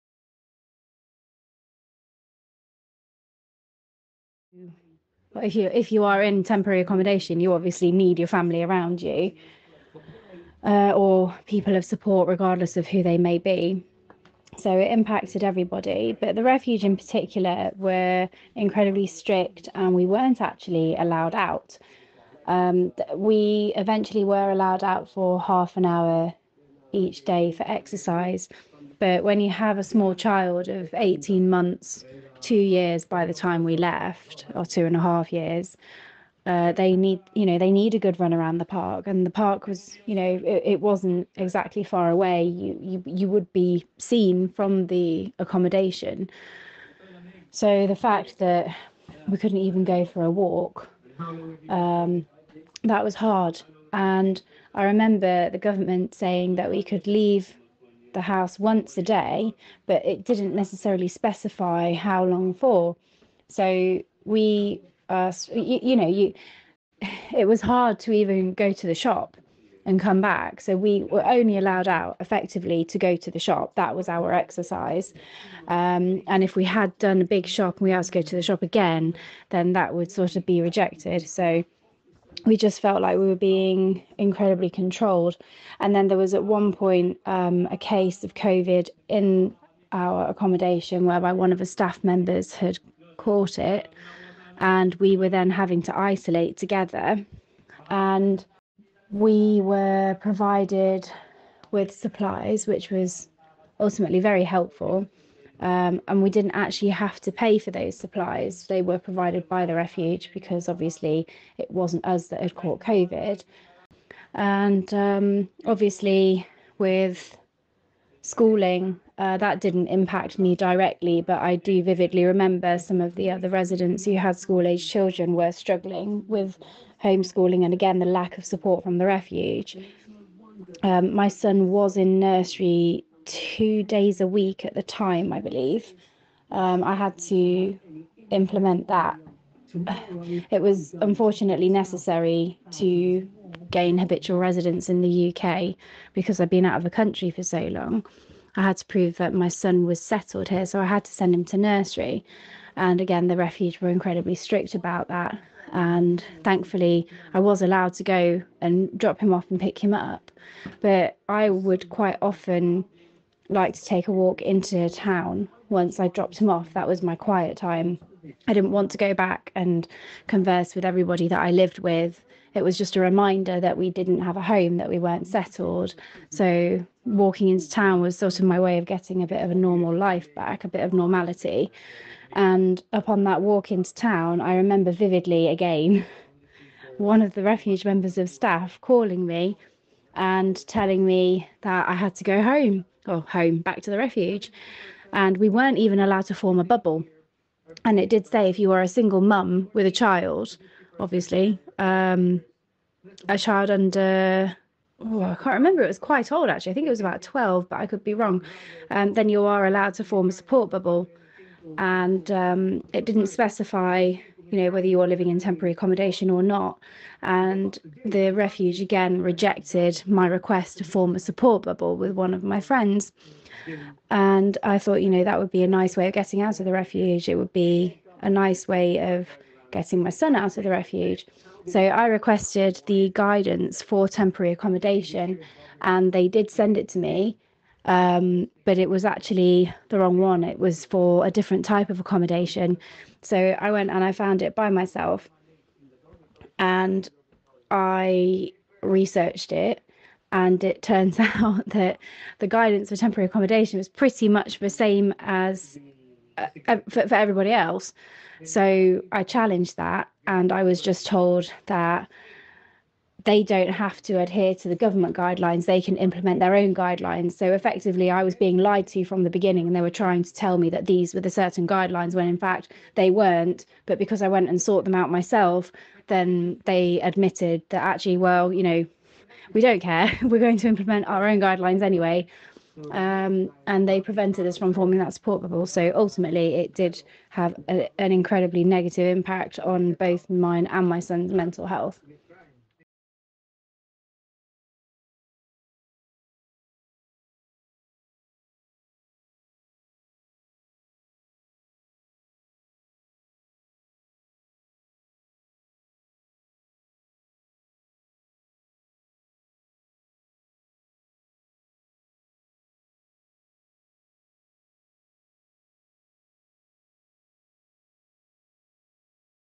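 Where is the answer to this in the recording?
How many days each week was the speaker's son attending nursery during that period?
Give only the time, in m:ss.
2:13.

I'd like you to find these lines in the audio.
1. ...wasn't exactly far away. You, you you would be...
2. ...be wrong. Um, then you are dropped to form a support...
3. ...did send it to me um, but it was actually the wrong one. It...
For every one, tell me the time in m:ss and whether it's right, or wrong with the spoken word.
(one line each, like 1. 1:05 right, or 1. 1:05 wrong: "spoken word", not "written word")
1. 0:40 right
2. 3:28 wrong: "allowed", not "dropped"
3. 3:56 right.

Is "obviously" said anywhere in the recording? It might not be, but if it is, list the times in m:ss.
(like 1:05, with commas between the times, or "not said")
0:07, 1:50, 1:55, 3:20.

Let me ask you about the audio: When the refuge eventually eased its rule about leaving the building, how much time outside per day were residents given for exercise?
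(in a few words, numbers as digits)
half an hour.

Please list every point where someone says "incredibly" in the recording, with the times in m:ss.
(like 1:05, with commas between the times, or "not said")
0:18, 1:24, 2:33, 4:48.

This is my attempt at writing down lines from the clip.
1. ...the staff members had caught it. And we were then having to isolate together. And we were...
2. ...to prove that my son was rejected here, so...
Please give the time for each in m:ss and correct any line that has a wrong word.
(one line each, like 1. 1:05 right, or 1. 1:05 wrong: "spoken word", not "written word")
1. 1:31 right
2. 2:28 wrong: "settled", not "rejected".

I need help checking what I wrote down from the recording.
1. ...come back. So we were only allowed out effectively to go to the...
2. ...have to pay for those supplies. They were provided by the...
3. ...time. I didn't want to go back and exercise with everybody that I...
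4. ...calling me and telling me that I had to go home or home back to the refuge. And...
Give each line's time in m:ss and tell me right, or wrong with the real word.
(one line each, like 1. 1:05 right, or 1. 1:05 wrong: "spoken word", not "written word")
1. 1:09 right
2. 1:46 right
3. 2:47 wrong: "converse", not "exercise"
4. 3:08 right.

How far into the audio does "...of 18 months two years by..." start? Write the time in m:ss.
0:30.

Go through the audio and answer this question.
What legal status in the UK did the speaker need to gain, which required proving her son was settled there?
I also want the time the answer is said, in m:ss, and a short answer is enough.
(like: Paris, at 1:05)
habitual residence, at 2:23.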